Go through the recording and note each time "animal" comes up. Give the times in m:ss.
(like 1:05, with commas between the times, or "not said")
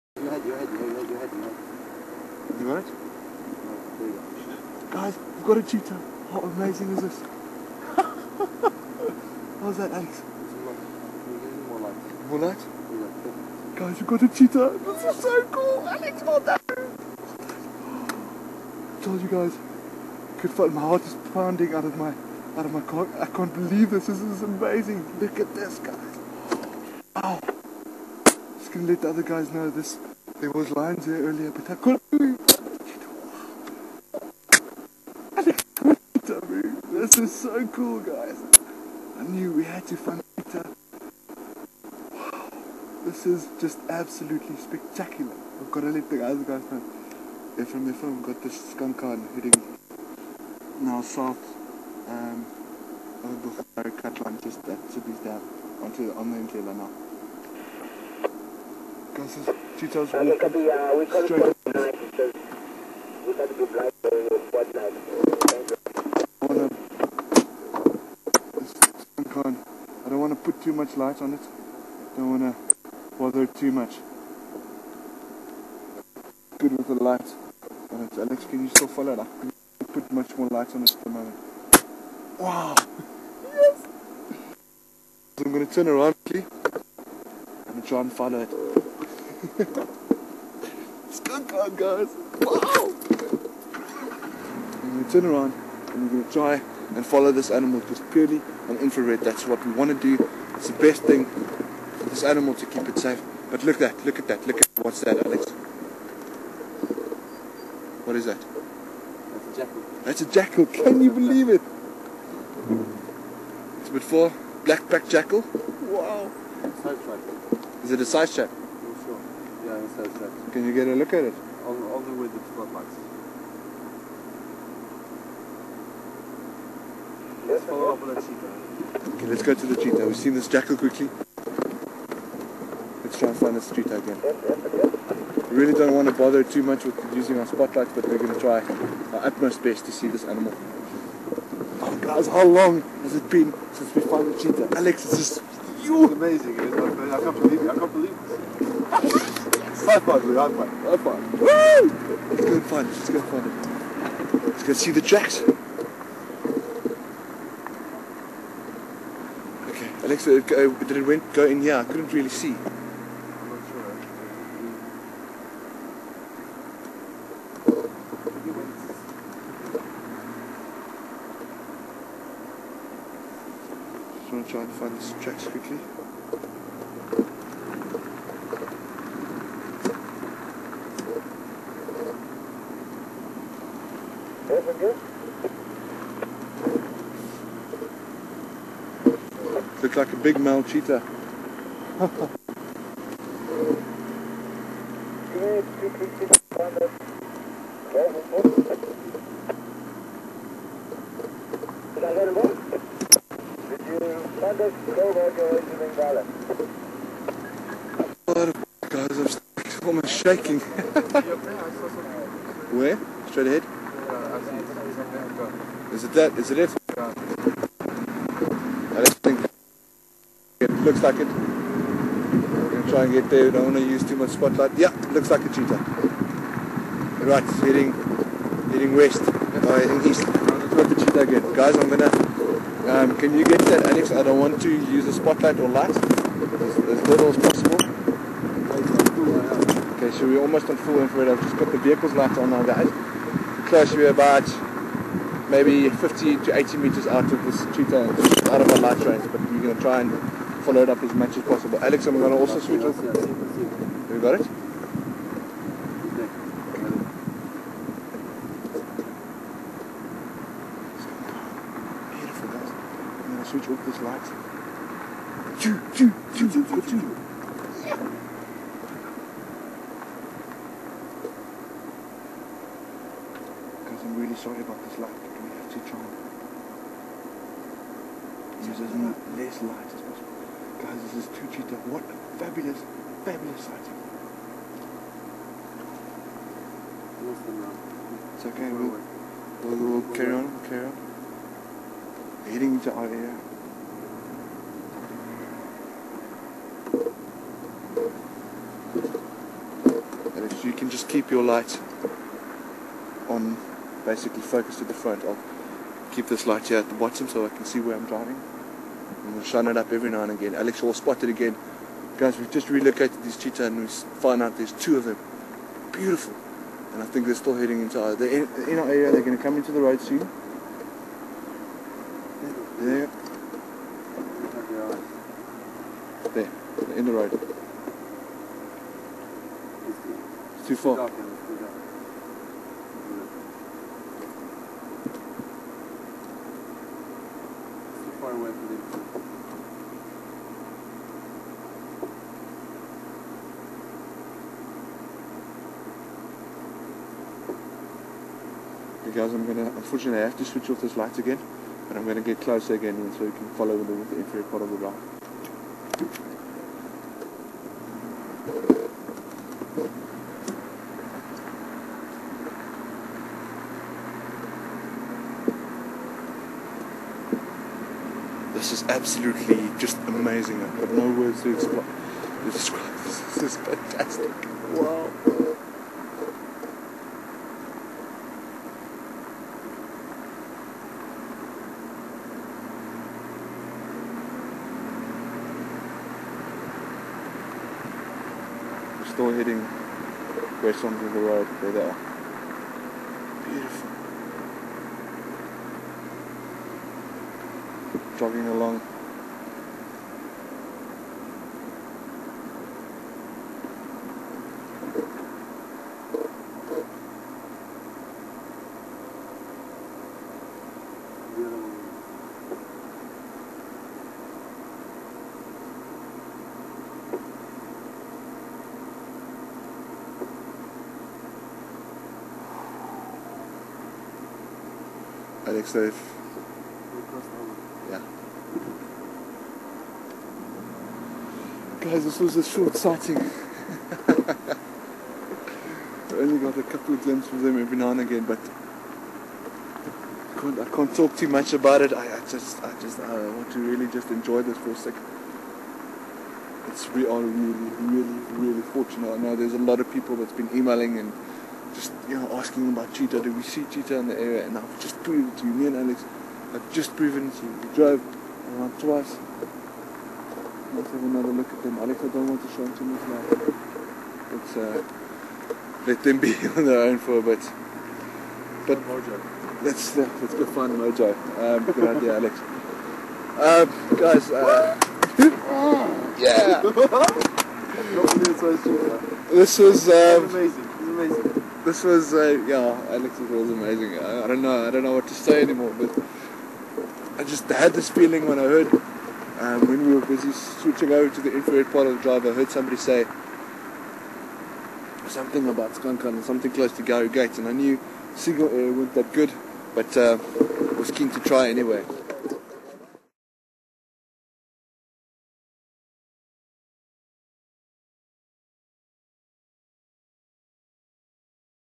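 1:37, 1:42, 2:20.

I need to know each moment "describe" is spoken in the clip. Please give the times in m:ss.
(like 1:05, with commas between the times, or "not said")
6:12.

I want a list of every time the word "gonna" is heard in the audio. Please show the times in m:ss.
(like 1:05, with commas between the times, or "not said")
0:28.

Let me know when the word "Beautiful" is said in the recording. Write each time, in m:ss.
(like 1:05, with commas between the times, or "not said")
4:22, 5:15, 6:33.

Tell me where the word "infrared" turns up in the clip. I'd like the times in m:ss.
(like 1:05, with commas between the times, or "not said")
1:38, 4:00, 5:54, 8:11.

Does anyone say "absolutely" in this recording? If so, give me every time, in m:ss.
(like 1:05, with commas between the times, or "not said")
0:43, 6:08.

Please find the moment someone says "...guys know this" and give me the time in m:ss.
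0:29.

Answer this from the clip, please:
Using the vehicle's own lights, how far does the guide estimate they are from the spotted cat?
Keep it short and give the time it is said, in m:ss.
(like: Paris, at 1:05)
50 to 80 meters, at 4:05.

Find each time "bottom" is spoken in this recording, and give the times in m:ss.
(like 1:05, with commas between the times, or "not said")
5:06.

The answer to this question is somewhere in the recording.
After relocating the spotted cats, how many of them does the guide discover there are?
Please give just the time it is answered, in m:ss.
5:14.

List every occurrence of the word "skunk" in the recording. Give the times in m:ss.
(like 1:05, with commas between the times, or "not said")
0:48, 8:15.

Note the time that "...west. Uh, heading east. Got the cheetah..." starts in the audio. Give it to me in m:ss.
3:48.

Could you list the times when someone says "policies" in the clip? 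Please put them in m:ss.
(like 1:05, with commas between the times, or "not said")
not said.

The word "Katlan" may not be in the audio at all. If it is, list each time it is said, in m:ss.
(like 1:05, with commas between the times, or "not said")
0:54.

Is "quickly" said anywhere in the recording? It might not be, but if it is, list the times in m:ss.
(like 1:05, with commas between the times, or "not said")
1:26, 2:10, 2:55.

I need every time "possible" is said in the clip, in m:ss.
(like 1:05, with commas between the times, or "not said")
3:57, 4:11, 4:40.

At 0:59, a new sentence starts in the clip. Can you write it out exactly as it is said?
Francis Tito's walking uh, straight up.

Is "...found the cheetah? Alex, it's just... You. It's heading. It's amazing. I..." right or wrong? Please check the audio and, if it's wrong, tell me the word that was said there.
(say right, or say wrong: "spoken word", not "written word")
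wrong: "amazing", not "heading".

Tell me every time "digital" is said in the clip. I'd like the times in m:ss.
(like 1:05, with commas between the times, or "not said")
not said.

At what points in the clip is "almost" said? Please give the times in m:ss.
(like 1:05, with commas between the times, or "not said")
3:29, 4:00.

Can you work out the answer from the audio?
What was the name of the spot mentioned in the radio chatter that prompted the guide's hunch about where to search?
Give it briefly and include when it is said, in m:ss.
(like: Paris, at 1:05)
Gary Gates, at 8:16.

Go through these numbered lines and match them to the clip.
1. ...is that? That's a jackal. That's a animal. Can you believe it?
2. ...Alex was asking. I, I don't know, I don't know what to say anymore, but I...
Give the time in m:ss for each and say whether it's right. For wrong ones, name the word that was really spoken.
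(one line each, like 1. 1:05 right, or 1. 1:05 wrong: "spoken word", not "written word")
1. 1:48 wrong: "jackal", not "animal"
2. 8:02 wrong: "amazing", not "asking".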